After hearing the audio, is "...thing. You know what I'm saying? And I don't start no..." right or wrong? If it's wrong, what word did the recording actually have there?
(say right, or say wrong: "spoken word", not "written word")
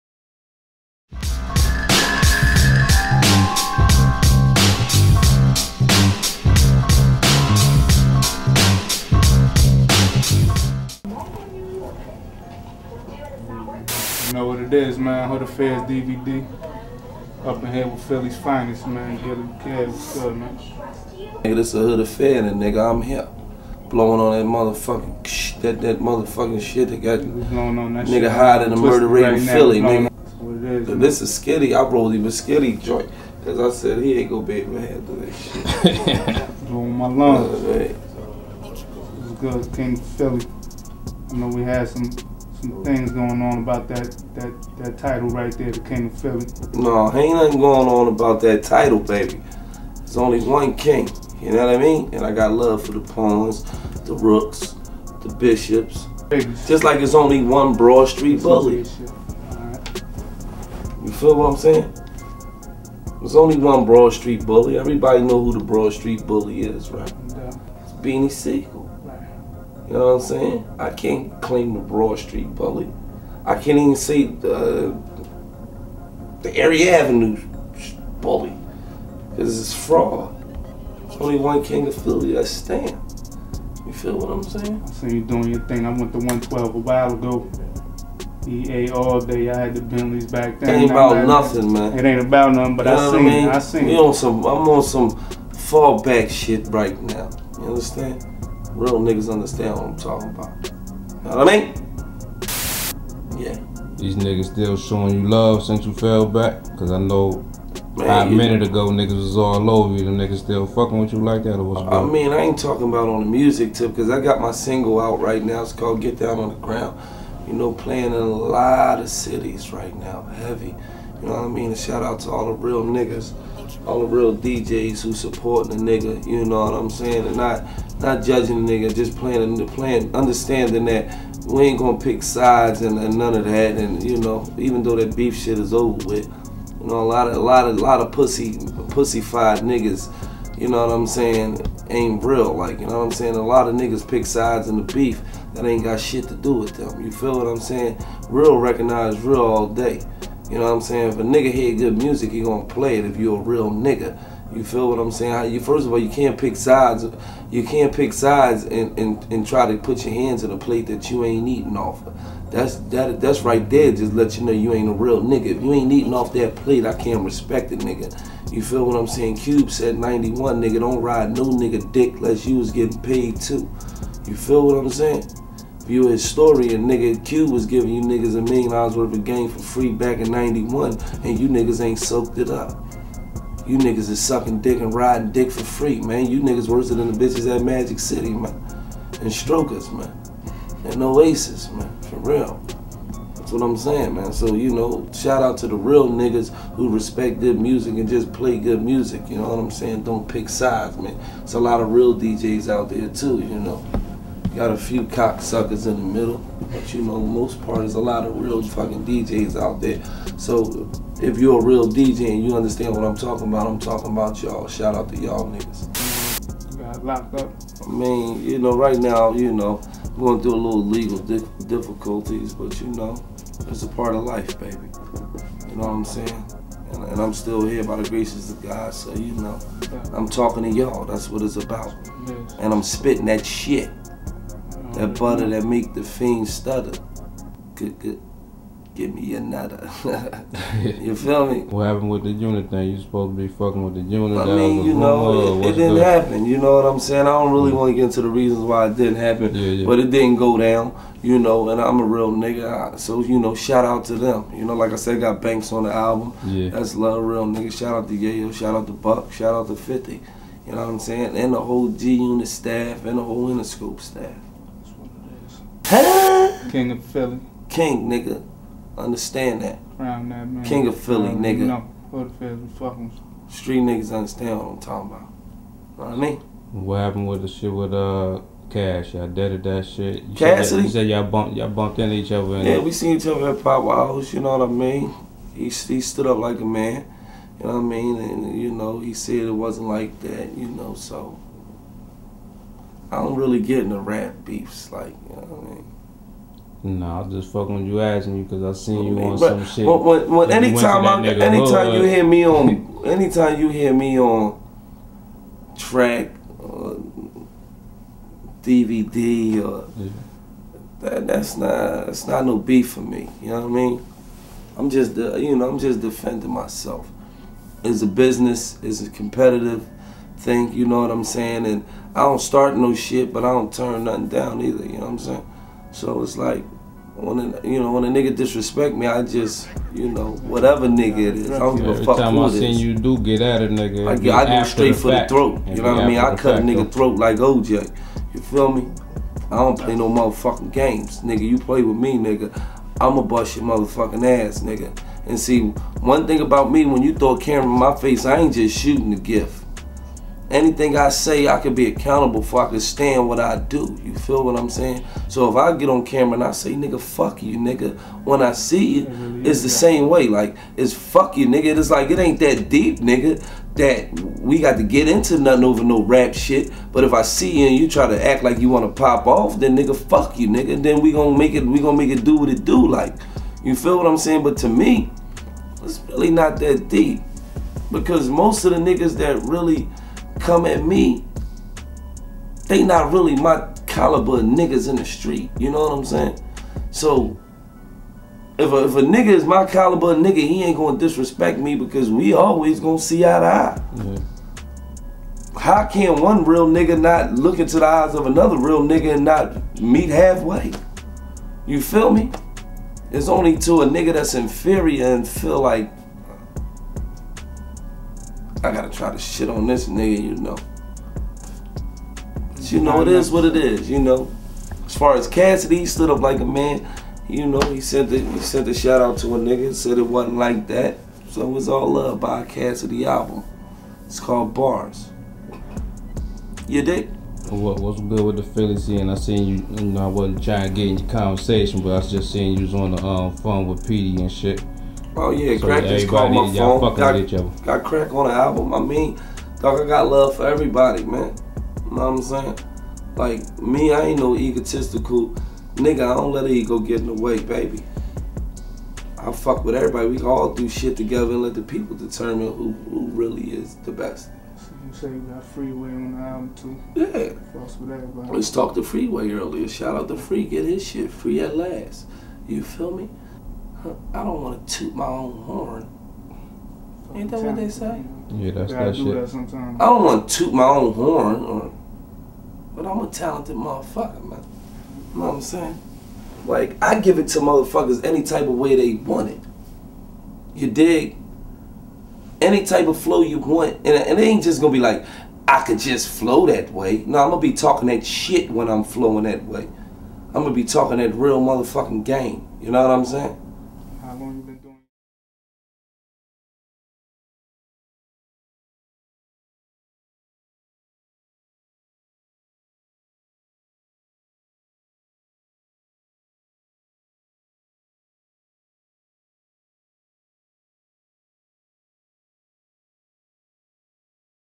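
right.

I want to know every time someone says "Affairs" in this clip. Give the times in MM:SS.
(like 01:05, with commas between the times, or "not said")
00:15, 00:21.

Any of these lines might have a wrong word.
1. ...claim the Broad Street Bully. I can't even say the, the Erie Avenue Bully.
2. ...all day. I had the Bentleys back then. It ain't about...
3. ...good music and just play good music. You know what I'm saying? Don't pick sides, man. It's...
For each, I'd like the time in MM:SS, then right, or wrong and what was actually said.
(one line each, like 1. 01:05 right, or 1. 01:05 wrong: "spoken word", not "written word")
1. 01:11 right
2. 01:28 right
3. 03:17 right.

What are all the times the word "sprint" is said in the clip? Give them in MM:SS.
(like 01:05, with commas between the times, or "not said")
not said.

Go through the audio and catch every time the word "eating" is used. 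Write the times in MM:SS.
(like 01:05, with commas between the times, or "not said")
02:41, 02:45.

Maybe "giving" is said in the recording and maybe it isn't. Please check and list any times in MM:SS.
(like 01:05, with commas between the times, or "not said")
02:57.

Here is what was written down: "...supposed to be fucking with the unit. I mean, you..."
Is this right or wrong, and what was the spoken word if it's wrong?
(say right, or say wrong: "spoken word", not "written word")
right.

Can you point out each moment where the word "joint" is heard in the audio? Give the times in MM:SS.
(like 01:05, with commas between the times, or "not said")
00:32.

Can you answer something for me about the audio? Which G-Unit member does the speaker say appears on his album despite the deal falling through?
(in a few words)
Banks.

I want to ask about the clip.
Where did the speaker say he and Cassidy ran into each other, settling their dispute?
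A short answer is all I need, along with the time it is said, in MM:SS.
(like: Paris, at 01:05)
Pop House, at 04:43.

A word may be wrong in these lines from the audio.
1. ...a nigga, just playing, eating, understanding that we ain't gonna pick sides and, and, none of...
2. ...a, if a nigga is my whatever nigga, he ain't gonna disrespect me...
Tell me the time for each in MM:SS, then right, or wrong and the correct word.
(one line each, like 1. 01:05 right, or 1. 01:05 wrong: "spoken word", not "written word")
1. 02:08 wrong: "playing", not "eating"
2. 06:28 wrong: "caliber", not "whatever".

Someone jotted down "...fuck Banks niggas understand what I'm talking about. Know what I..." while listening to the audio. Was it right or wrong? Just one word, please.
wrong.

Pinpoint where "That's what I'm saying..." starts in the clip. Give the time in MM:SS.
03:13.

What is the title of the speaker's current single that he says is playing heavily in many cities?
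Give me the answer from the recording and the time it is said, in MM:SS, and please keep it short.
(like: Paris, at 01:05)
Get Down on the Ground, at 01:55.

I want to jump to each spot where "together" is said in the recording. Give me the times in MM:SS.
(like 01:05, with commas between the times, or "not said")
07:30.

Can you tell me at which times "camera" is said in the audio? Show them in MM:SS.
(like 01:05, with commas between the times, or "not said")
05:47, 05:56.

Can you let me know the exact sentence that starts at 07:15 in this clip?
Oh yeah, so Crakk just called my phone.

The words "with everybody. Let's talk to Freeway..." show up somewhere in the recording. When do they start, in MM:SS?
07:37.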